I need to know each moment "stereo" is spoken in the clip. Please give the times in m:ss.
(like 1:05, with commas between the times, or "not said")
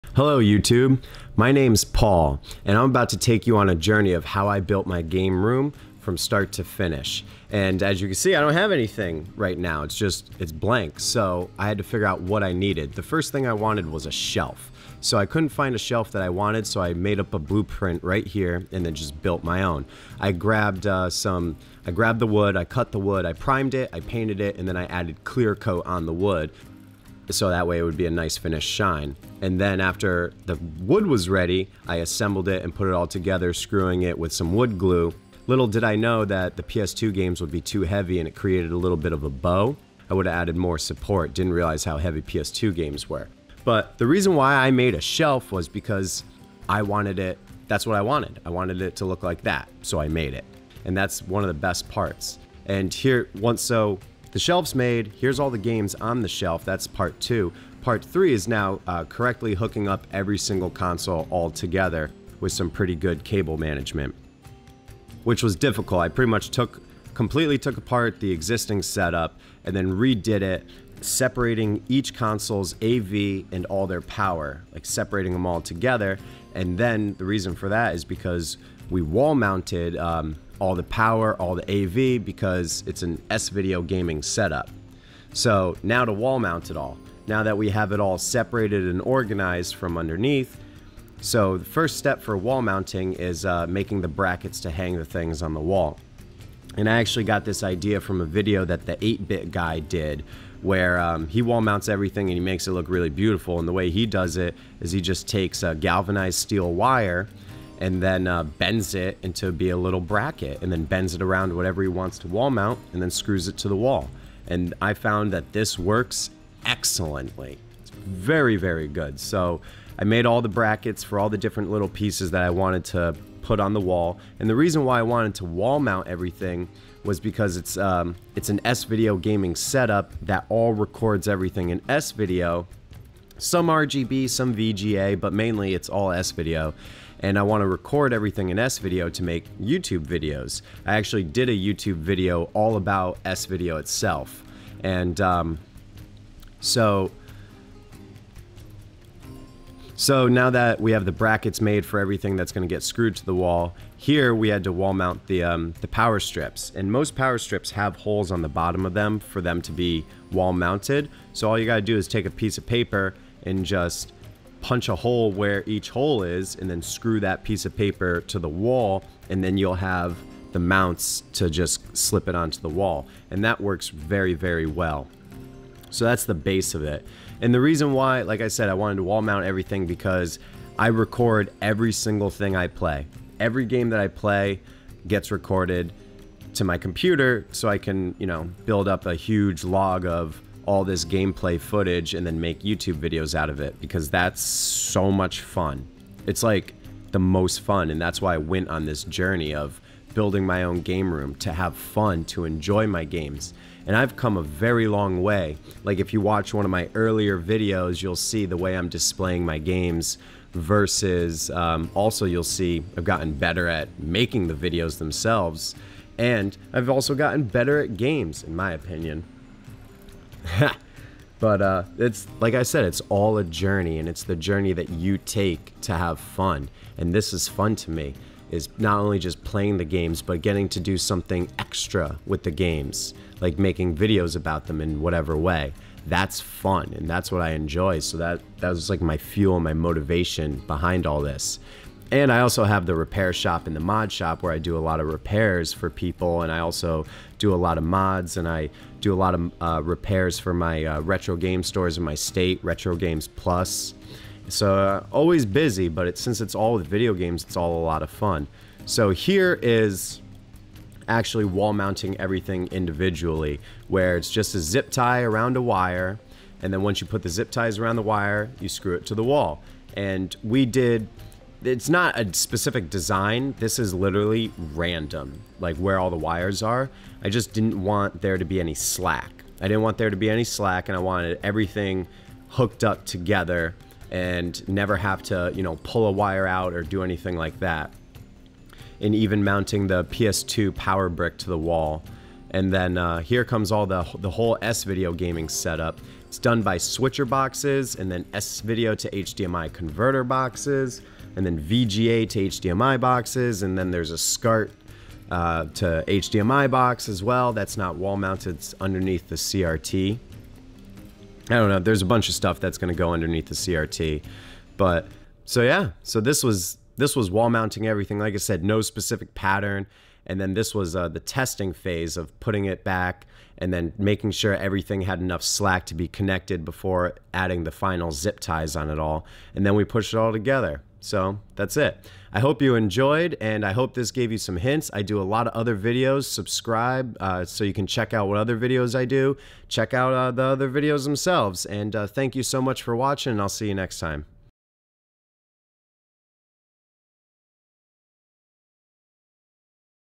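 not said.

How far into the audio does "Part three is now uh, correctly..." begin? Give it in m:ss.
0:57.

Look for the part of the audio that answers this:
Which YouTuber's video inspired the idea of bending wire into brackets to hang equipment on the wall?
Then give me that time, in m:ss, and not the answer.
1:38.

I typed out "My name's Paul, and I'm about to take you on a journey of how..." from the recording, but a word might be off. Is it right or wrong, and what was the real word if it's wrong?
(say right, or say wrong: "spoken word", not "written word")
right.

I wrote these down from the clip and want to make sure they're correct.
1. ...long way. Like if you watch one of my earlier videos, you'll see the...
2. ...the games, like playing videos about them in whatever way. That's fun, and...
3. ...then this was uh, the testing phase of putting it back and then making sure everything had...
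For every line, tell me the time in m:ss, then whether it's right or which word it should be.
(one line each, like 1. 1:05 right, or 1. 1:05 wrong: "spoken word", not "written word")
1. 3:24 right
2. 3:52 wrong: "making", not "playing"
3. 5:20 right.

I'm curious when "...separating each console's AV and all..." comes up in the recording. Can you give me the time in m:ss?
1:11.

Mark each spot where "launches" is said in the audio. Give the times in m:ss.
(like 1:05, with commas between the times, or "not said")
not said.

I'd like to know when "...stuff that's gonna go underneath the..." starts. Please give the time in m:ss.
5:12.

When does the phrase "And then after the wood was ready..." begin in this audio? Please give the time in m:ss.
0:29.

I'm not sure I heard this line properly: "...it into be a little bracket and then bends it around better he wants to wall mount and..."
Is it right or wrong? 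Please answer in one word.
wrong.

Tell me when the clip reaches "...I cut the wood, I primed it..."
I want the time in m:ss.
0:22.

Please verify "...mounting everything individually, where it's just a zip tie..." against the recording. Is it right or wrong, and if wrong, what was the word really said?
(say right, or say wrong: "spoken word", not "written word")
right.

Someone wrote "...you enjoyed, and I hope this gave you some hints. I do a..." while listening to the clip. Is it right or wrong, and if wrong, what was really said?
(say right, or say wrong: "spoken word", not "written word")
right.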